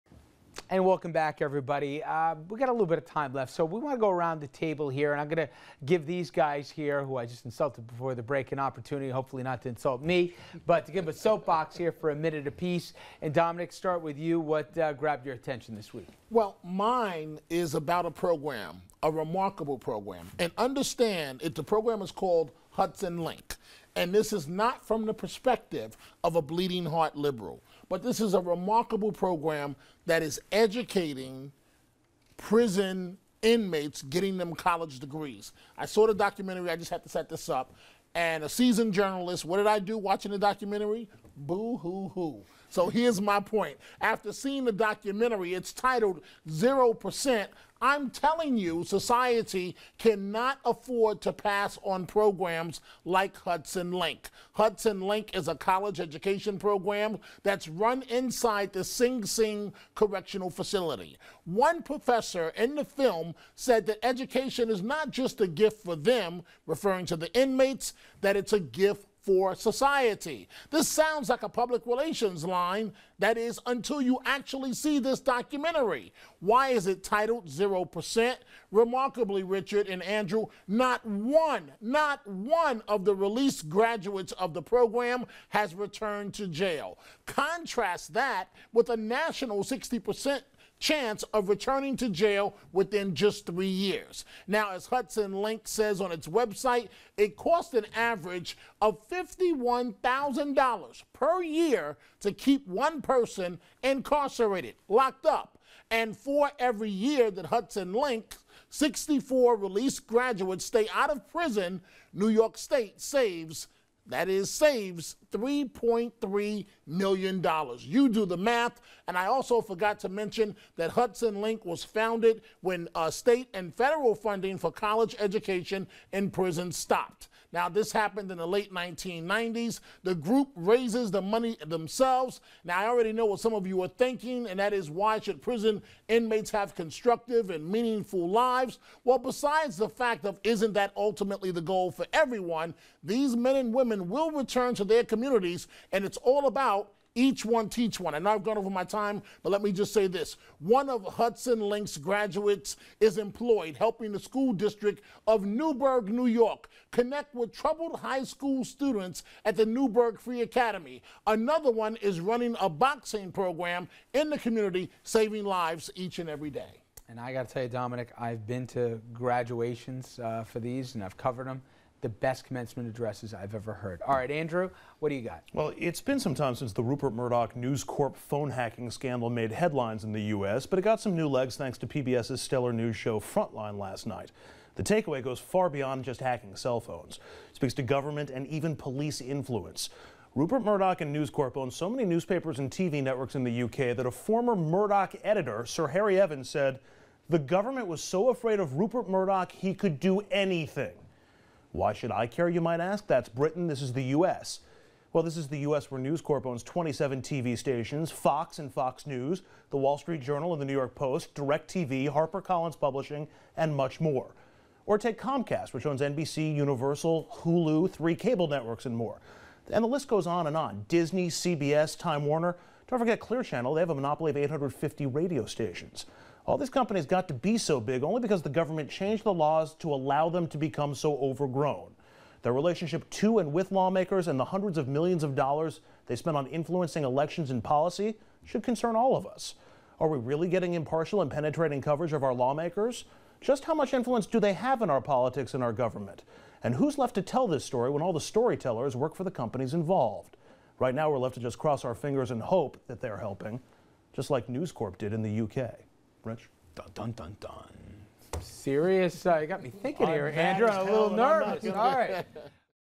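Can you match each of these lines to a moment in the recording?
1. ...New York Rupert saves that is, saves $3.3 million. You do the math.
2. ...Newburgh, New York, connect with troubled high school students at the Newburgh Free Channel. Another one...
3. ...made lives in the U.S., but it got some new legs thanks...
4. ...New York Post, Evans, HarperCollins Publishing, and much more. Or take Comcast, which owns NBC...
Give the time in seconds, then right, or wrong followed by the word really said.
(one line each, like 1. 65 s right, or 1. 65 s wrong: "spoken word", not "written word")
1. 112 s wrong: "State", not "Rupert"
2. 155 s wrong: "Academy", not "Channel"
3. 179 s wrong: "headlines", not "lives"
4. 210 s wrong: "DirecTV", not "Evans".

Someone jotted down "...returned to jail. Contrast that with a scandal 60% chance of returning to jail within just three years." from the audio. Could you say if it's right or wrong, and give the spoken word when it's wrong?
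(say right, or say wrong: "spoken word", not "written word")
wrong: "national", not "scandal".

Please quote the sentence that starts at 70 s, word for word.
This sounds like a public relations line, that is, until you actually see this documentary.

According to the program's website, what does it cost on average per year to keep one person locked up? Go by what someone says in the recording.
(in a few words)
$51,000.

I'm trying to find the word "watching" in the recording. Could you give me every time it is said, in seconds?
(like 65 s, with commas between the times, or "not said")
39 s.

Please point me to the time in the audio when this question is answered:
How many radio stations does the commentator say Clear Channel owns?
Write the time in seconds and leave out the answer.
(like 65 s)
224 s.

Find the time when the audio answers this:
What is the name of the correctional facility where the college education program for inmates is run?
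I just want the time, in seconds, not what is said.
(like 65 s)
58 s.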